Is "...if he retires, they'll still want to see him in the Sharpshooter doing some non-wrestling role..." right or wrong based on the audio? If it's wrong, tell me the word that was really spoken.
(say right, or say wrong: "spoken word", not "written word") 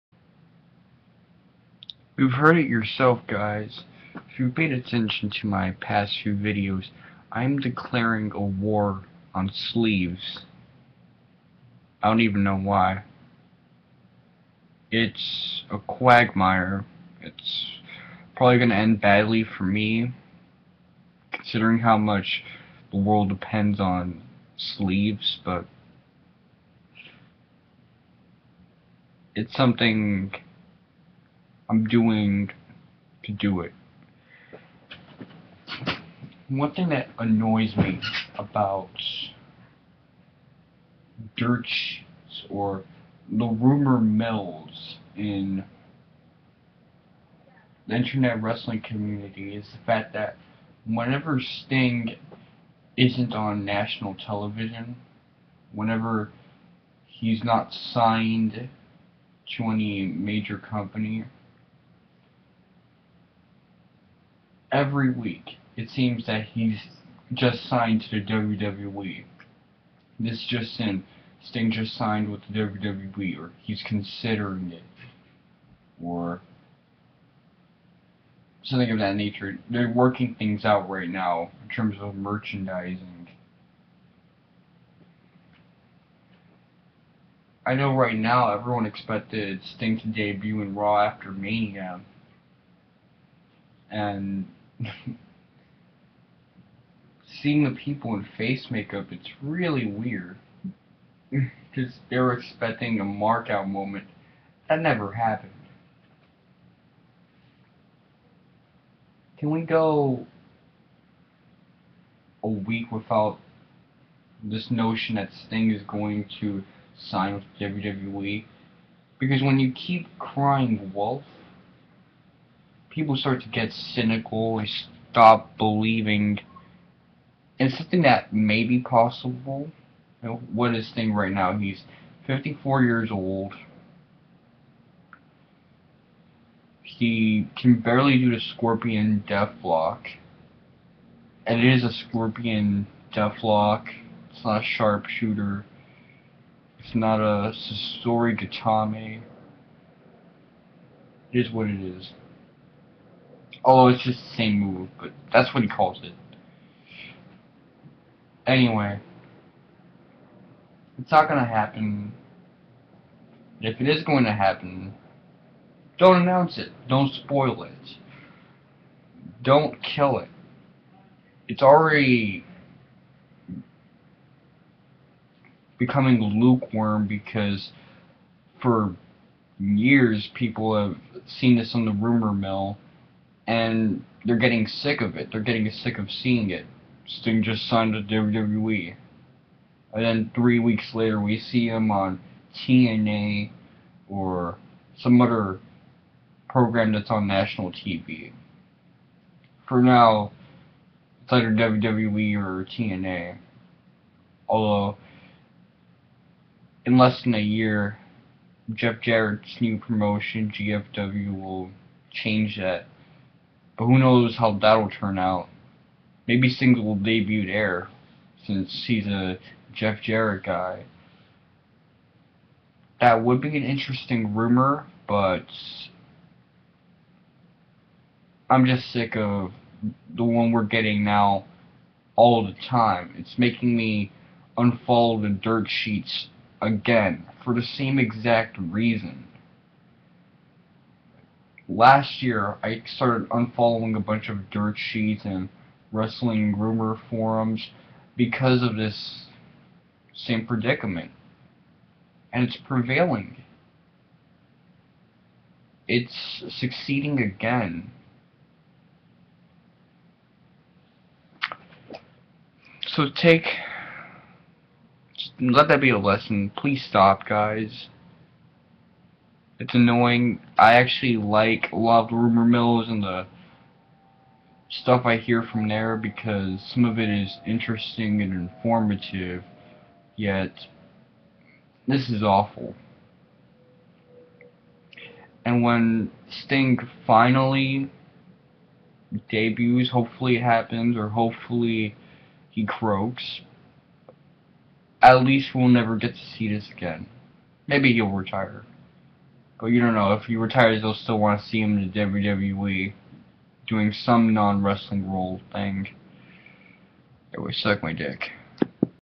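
wrong: "WWE", not "Sharpshooter".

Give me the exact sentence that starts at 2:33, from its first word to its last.
Although it's just the same move, but that's what he calls it.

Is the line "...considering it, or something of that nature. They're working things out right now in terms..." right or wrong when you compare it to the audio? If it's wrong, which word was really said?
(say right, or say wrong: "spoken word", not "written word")
right.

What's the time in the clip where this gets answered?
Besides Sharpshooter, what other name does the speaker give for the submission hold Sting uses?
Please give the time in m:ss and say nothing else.
2:27.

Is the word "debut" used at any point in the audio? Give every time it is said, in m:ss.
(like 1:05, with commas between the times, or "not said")
1:30, 3:36, 4:49.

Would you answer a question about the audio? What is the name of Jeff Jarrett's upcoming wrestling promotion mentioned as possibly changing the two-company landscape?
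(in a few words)
GFW.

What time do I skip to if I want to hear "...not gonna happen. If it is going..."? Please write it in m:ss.
2:41.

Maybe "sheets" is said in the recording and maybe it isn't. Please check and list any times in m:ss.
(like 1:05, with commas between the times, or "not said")
3:55, 4:04.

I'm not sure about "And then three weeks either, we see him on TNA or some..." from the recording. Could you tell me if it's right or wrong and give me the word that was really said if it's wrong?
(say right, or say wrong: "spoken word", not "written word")
wrong: "later", not "either".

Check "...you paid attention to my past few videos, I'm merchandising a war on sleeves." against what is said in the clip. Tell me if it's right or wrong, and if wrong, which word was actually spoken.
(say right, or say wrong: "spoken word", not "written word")
wrong: "declaring", not "merchandising".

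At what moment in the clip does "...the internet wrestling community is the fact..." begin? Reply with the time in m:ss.
0:47.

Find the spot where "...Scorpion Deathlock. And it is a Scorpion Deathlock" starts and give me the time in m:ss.
2:18.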